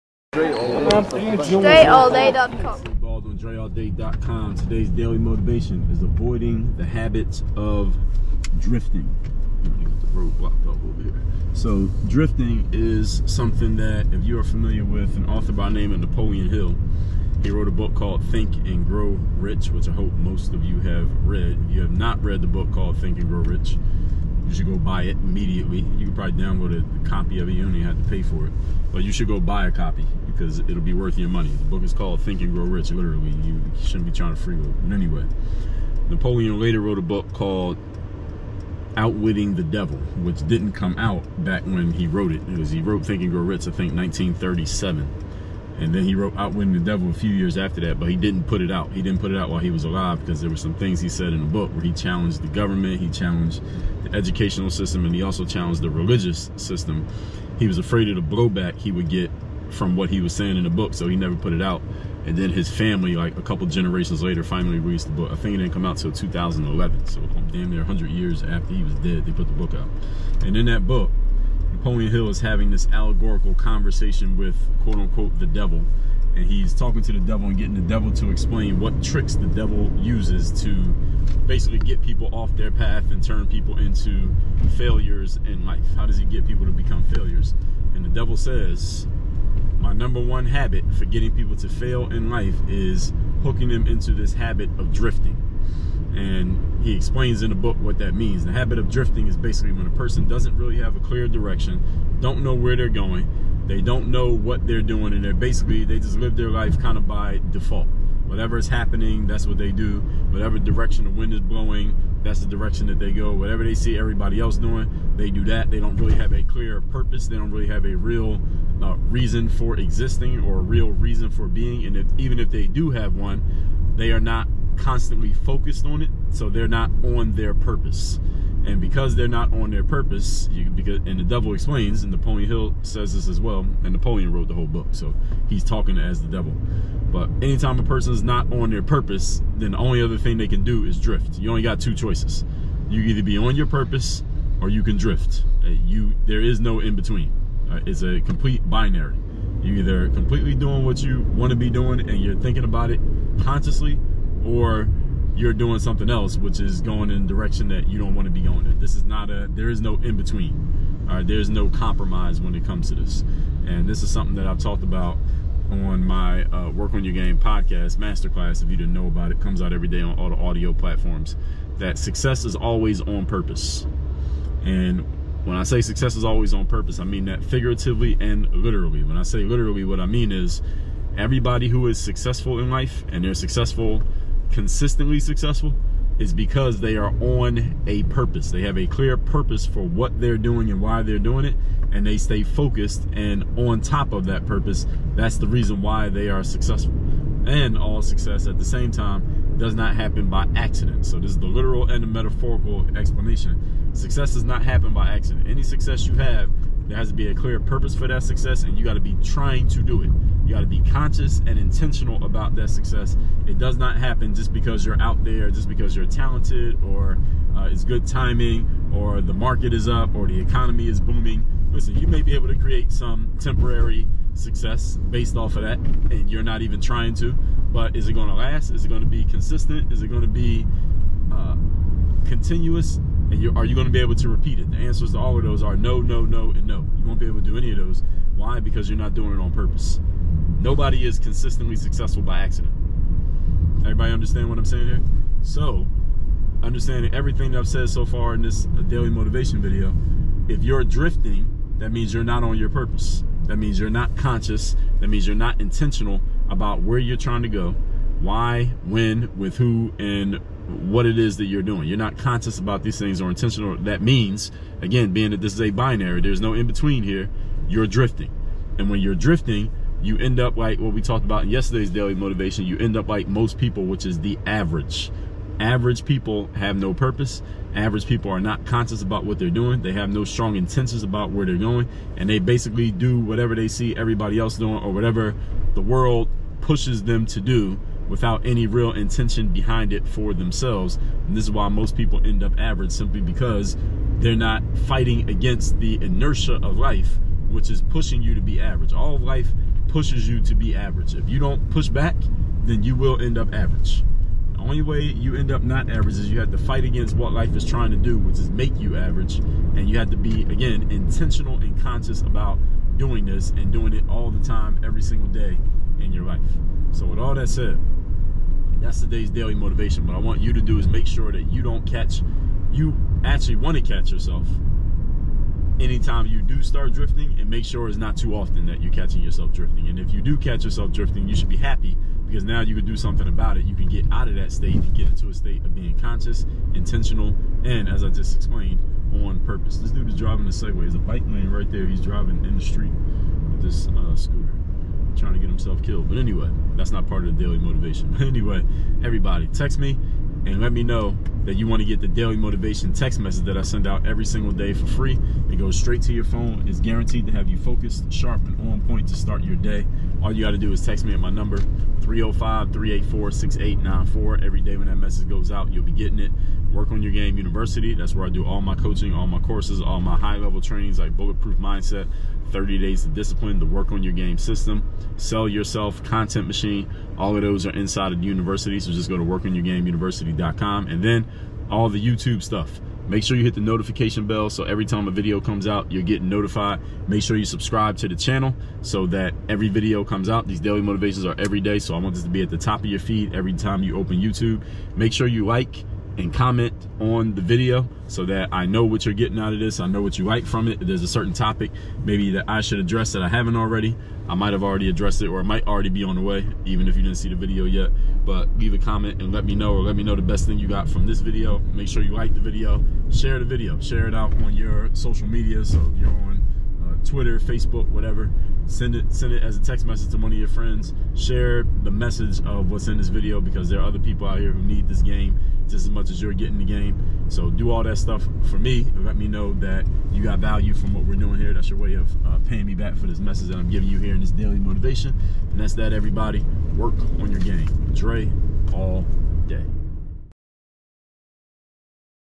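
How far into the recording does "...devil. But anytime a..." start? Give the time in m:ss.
2:16.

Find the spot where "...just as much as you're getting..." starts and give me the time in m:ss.
7:05.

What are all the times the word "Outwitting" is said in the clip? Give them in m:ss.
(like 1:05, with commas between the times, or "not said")
0:38, 0:46.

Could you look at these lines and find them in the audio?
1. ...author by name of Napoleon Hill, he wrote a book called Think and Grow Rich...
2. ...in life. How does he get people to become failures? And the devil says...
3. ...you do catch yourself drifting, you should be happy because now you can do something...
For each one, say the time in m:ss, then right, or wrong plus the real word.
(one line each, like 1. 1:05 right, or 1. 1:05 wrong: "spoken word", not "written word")
1. 0:15 right
2. 1:25 right
3. 5:30 right.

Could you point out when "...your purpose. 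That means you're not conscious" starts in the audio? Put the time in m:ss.
4:12.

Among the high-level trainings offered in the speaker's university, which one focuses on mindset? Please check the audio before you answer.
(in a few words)
Bulletproof Mindset.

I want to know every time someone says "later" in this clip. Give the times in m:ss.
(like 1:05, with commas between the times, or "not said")
0:36, 1:04.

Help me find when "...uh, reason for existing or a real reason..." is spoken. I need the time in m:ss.
1:58.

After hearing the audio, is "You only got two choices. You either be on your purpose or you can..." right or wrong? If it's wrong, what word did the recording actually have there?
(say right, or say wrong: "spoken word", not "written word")
right.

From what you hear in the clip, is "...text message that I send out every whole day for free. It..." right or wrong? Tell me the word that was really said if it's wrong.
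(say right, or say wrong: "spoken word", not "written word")
wrong: "single", not "whole".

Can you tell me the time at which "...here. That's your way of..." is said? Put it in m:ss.
7:11.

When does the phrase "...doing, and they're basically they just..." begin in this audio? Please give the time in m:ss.
1:44.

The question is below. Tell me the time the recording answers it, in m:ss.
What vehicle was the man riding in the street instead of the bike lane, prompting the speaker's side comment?
5:40.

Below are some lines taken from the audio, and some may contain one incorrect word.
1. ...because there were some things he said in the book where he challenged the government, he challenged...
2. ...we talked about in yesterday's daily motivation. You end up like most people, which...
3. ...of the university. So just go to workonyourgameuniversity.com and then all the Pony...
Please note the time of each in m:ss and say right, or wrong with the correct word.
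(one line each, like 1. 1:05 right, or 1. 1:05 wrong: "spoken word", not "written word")
1. 0:50 right
2. 4:30 right
3. 6:18 wrong: "YouTube", not "Pony".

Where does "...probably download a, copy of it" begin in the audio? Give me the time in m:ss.
0:26.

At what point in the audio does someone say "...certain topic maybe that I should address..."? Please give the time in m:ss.
6:41.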